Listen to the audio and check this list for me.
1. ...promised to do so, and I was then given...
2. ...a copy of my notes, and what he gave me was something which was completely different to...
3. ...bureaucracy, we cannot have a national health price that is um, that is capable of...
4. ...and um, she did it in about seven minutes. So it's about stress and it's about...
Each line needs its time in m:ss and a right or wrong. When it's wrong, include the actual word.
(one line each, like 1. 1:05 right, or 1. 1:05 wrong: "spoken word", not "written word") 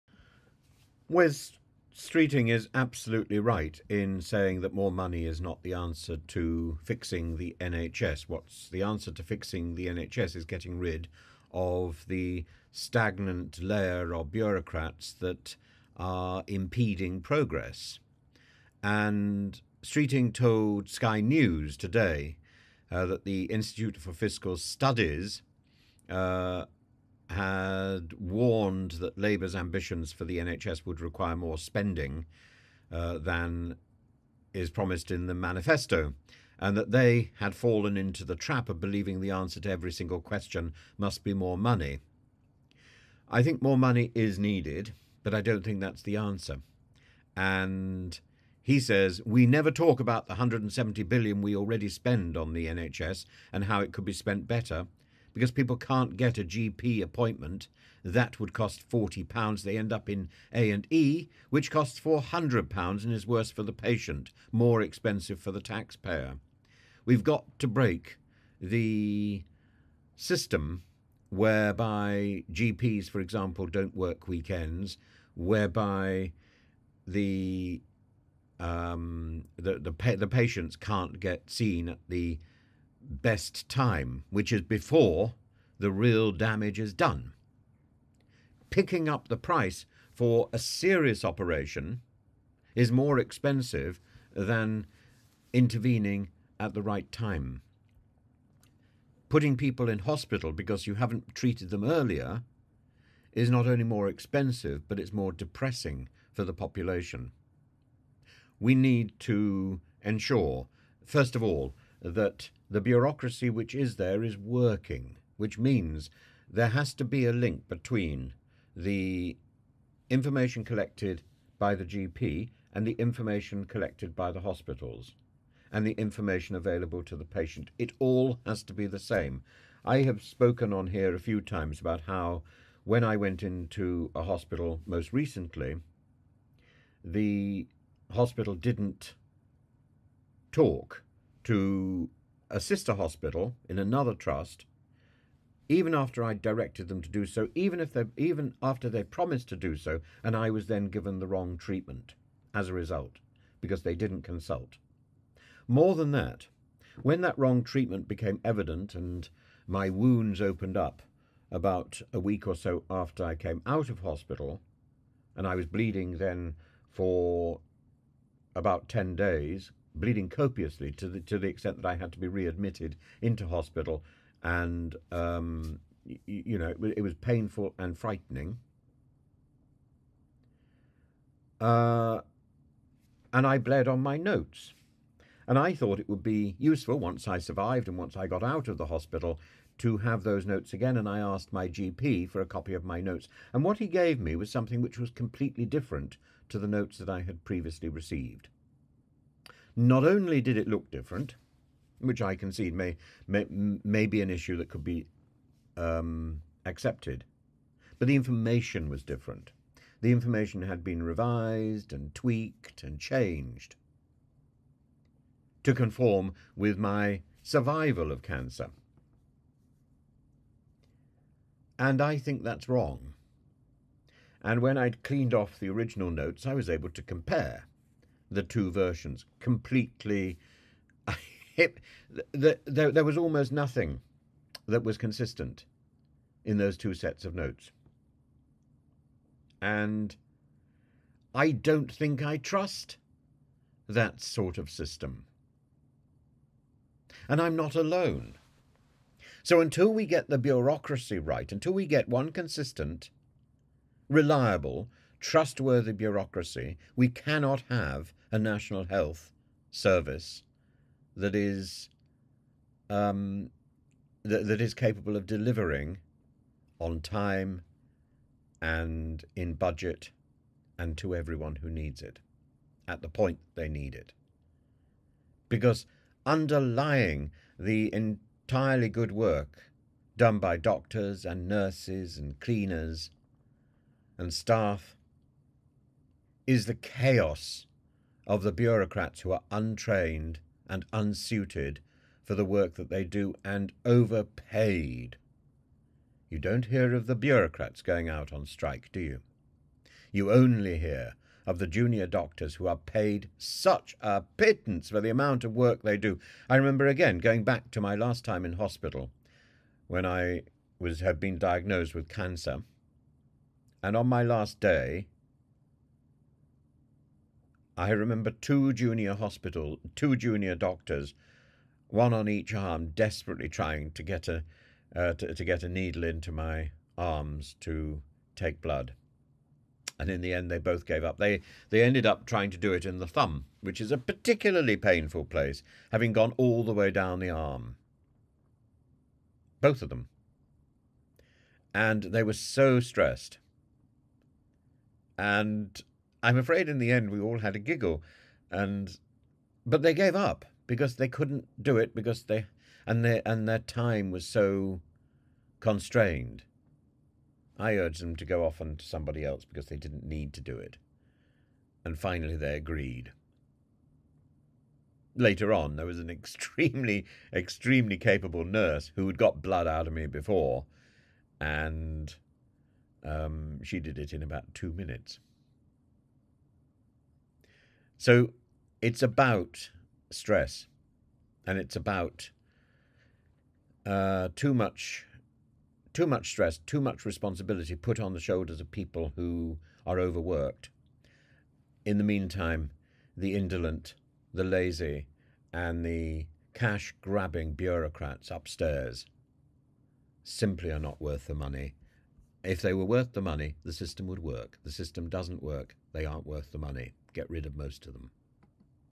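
1. 2:29 right
2. 3:12 right
3. 4:15 wrong: "service", not "price"
4. 6:11 wrong: "two", not "seven".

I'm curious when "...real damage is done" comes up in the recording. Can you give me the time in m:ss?
1:25.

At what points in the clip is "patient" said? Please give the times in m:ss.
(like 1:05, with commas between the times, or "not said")
1:03, 1:20, 2:07.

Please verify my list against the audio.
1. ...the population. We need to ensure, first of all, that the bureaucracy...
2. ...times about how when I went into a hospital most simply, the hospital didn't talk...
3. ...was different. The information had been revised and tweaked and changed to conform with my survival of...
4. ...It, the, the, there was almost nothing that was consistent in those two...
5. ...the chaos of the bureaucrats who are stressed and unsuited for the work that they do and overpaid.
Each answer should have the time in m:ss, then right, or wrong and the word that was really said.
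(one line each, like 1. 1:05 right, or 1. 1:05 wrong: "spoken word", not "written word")
1. 1:46 right
2. 2:11 wrong: "recently", not "simply"
3. 3:28 right
4. 3:51 right
5. 4:46 wrong: "untrained", not "stressed".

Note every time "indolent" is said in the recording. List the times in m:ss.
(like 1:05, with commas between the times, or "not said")
6:33.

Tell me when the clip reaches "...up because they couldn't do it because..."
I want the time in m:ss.
5:50.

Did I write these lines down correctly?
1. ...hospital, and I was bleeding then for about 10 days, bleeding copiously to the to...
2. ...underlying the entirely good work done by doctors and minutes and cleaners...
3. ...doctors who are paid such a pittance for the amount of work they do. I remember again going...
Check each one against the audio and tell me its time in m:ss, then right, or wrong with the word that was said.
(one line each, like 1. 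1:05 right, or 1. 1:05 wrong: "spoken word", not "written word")
1. 2:43 right
2. 4:36 wrong: "nurses", not "minutes"
3. 5:02 right.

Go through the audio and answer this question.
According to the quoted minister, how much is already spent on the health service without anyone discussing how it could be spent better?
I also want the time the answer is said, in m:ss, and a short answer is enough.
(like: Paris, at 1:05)
£170 billion, at 0:50.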